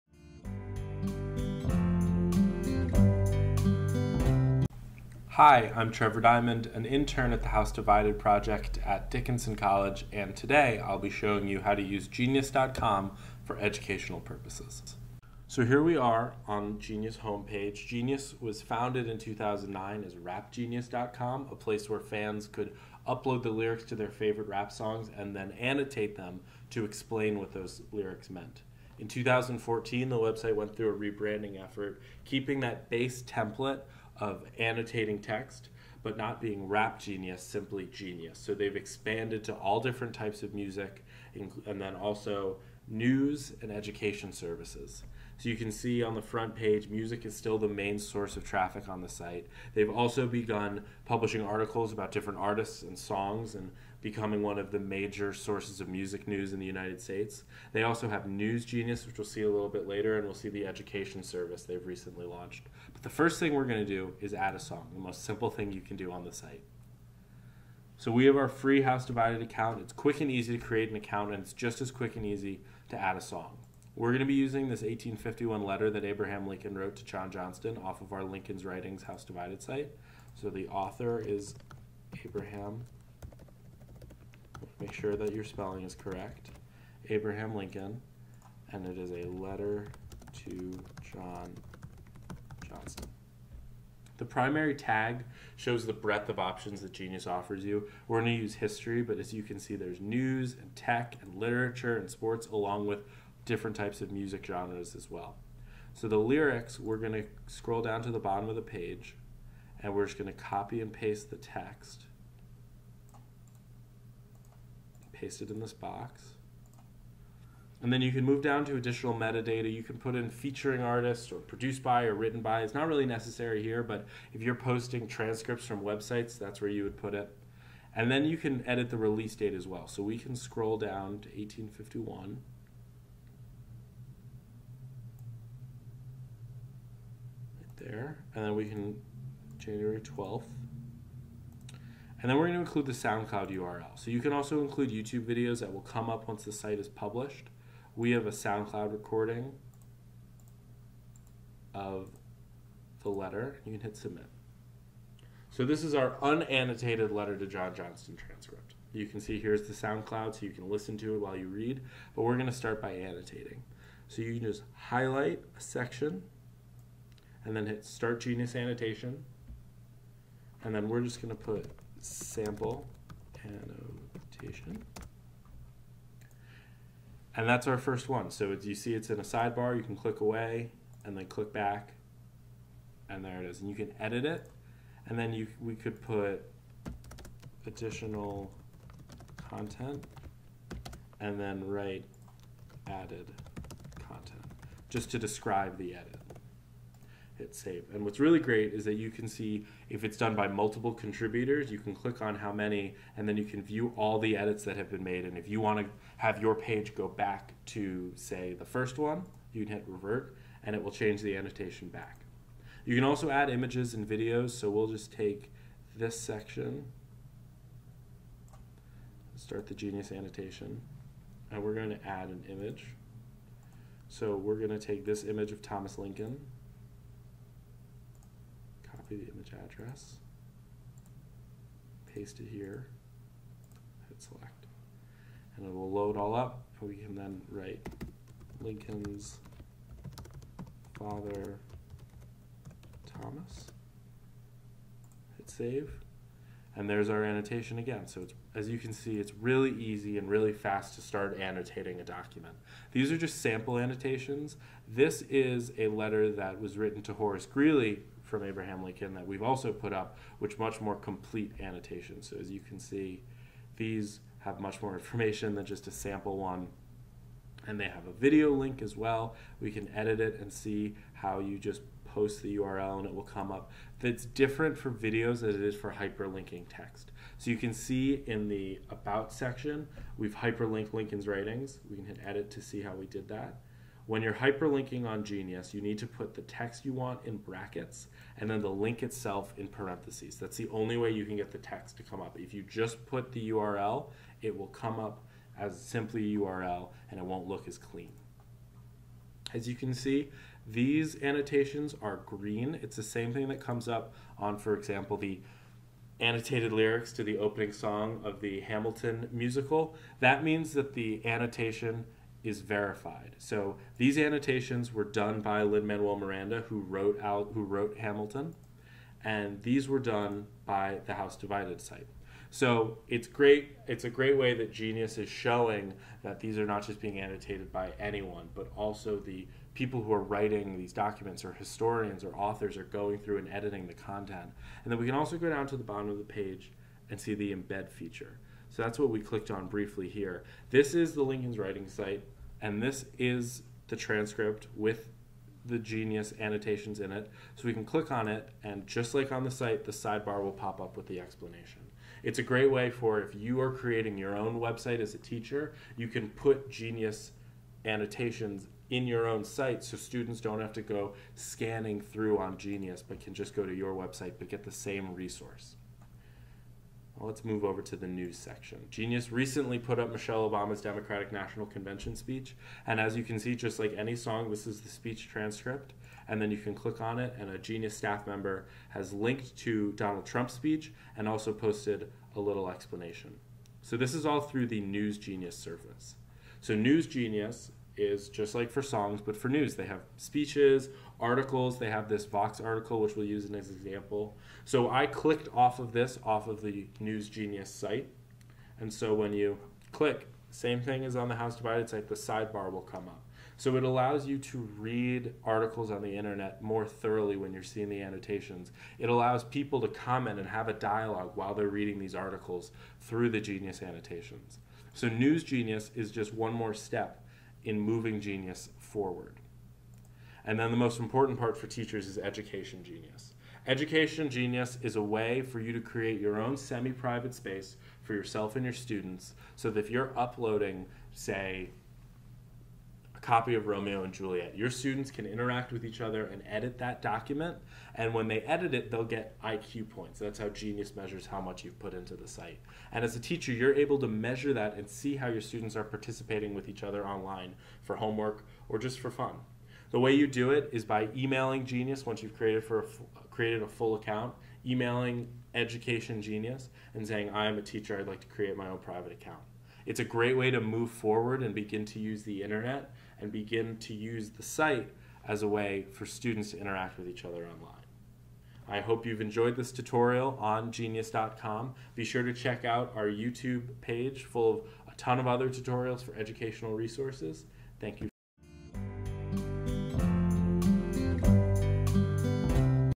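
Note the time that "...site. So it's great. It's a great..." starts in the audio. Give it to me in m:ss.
5:21.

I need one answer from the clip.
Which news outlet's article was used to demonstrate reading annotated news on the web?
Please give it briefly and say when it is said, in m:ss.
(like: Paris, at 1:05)
Vox, at 6:32.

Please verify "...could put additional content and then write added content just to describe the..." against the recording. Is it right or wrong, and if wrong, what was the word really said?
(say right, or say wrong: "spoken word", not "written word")
right.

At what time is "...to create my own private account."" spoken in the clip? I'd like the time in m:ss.
7:38.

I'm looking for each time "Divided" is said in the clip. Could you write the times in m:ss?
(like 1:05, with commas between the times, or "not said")
0:07, 1:09, 1:19, 5:21, 6:41.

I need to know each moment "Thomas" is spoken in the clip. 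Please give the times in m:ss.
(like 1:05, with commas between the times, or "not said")
3:45, 4:03.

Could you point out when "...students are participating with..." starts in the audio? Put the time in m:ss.
7:25.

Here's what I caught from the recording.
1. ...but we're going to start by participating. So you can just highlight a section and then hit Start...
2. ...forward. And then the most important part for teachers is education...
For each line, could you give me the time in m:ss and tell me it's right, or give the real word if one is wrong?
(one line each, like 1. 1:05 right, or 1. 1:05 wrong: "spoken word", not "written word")
1. 2:42 wrong: "annotating", not "participating"
2. 6:58 right.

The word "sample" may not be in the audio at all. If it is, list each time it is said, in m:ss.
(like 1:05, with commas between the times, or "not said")
2:52, 4:13, 4:25.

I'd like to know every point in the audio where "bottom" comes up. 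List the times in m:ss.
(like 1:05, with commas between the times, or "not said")
1:48, 5:35.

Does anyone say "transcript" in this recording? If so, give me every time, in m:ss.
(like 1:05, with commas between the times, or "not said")
2:05, 2:38, 5:43, 6:15.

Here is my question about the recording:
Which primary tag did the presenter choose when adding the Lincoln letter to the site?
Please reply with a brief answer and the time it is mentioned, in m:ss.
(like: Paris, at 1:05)
history, at 1:38.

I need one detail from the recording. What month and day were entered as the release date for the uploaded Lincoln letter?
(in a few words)
January 12th.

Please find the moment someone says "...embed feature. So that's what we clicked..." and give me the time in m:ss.
5:37.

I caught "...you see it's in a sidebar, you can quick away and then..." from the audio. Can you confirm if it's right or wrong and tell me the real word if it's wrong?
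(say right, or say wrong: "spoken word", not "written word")
wrong: "click", not "quick".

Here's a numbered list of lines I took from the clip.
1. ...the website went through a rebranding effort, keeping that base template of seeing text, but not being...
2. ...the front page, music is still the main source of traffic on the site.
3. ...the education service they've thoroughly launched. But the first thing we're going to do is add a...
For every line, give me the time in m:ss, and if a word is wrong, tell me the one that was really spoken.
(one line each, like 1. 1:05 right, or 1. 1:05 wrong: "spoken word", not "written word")
1. 0:30 wrong: "annotating", not "seeing"
2. 0:46 right
3. 1:00 wrong: "recently", not "thoroughly".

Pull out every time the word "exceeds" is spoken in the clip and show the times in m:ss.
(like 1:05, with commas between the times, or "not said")
not said.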